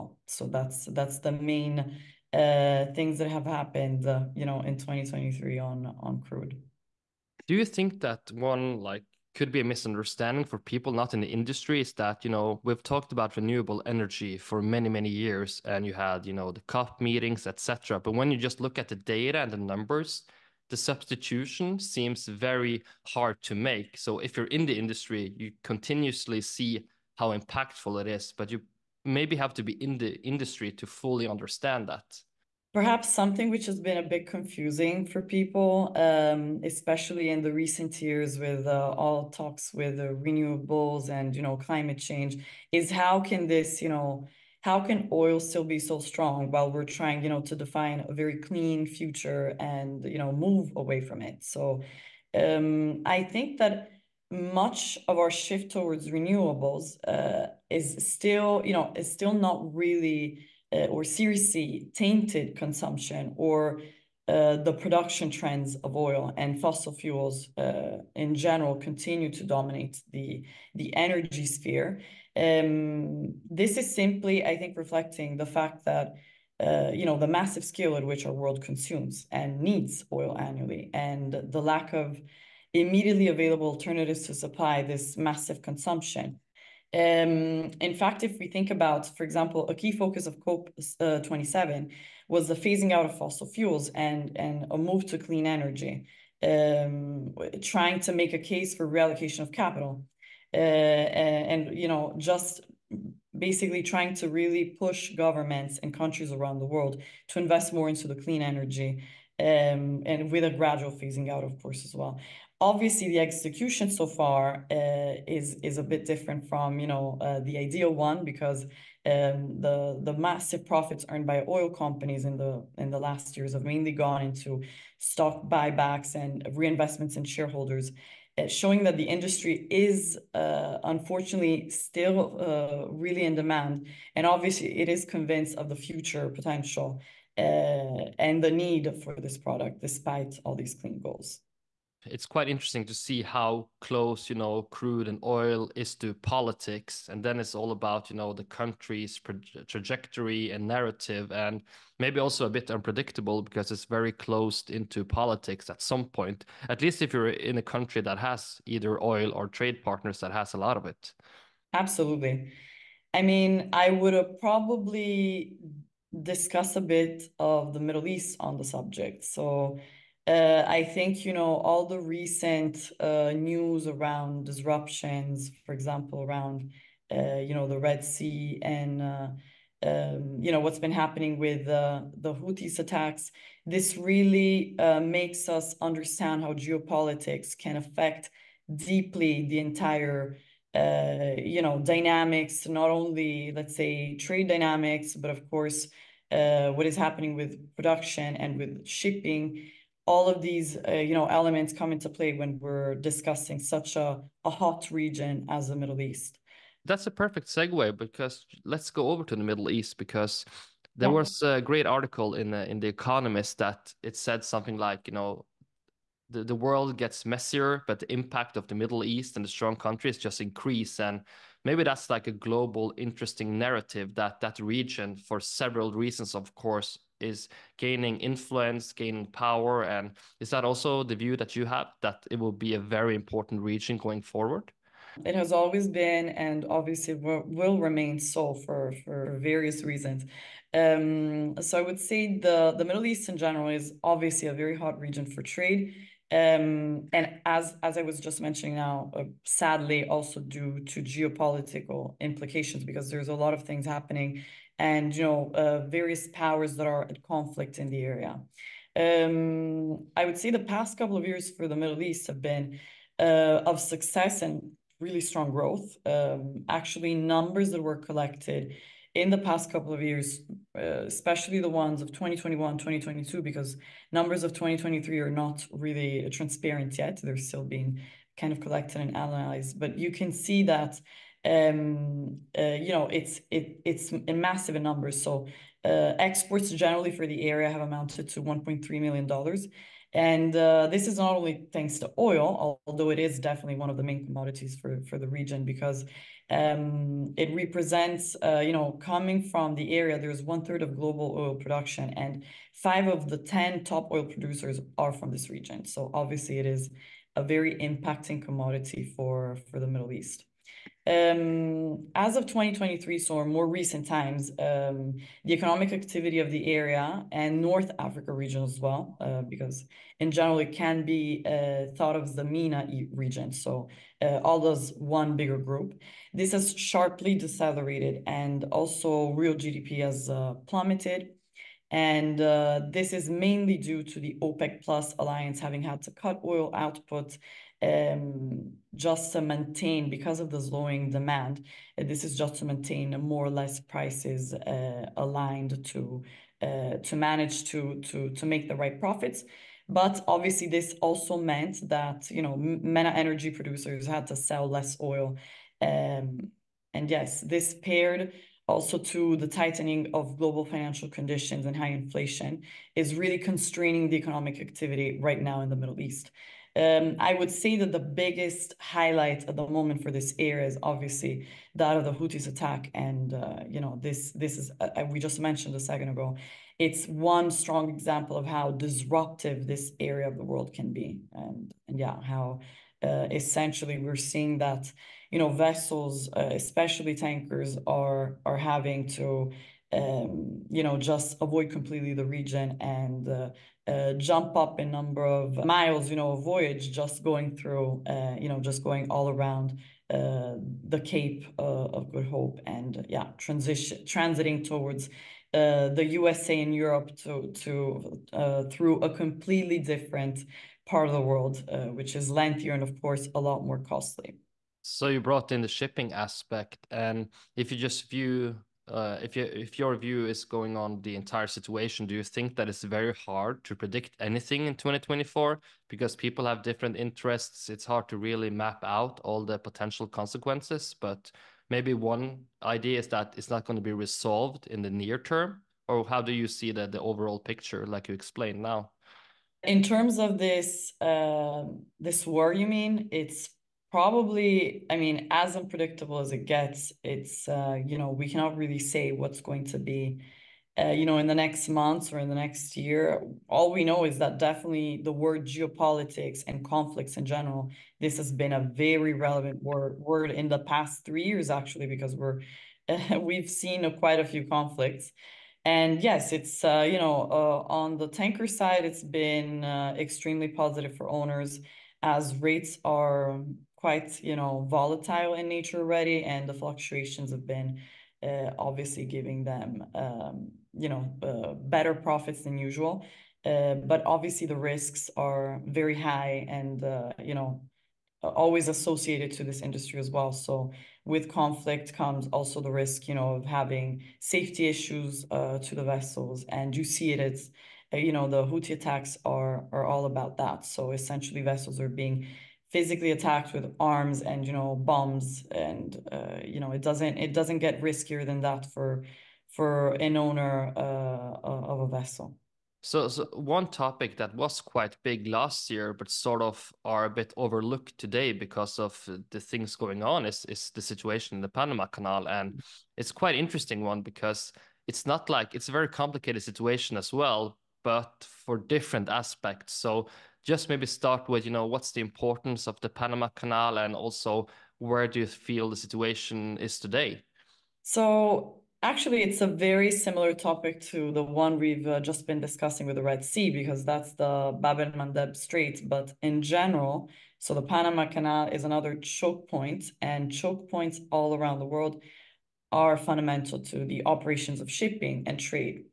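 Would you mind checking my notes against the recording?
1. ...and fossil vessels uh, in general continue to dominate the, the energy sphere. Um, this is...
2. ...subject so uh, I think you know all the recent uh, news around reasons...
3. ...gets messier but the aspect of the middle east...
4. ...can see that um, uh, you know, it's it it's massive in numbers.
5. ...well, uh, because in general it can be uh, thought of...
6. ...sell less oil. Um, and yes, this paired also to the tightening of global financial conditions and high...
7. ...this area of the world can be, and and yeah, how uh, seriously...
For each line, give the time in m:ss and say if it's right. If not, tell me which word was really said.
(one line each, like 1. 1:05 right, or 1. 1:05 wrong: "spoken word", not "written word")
1. 1:06 wrong: "fuels", not "vessels"
2. 2:48 wrong: "disruptions", not "reasons"
3. 3:36 wrong: "impact", not "aspect"
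4. 4:40 right
5. 5:18 right
6. 5:54 right
7. 6:19 wrong: "essentially", not "seriously".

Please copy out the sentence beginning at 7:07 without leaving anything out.
It's hard to really map out all the potential consequences.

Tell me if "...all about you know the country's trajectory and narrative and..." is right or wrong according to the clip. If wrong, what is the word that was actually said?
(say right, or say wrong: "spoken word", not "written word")
right.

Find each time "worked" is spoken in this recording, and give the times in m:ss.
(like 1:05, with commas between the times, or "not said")
not said.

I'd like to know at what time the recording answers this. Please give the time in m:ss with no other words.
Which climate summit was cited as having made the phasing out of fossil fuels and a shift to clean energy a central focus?
1:30.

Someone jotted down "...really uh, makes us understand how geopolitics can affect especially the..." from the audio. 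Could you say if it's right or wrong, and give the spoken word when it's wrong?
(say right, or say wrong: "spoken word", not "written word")
wrong: "deeply", not "especially".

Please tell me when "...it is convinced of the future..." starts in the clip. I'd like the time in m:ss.
2:14.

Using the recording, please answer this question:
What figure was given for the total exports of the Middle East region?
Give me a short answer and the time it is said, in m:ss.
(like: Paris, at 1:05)
1.3 million dollars, at 4:48.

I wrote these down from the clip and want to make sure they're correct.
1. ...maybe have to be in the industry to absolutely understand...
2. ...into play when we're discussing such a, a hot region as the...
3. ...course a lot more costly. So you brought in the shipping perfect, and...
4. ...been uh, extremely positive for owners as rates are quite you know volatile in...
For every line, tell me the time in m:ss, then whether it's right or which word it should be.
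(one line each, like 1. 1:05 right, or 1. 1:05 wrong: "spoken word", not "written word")
1. 0:29 wrong: "fully", not "absolutely"
2. 3:21 right
3. 6:52 wrong: "aspect", not "perfect"
4. 7:49 right.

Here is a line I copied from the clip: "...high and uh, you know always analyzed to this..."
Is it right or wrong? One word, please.
wrong.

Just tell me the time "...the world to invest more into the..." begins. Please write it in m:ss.
1:46.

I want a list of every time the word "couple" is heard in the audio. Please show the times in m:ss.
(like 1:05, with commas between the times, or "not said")
4:20, 4:29.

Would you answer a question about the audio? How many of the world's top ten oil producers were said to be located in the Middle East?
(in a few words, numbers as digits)
5.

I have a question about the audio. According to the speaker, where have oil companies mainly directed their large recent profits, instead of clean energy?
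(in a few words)
Stock buybacks.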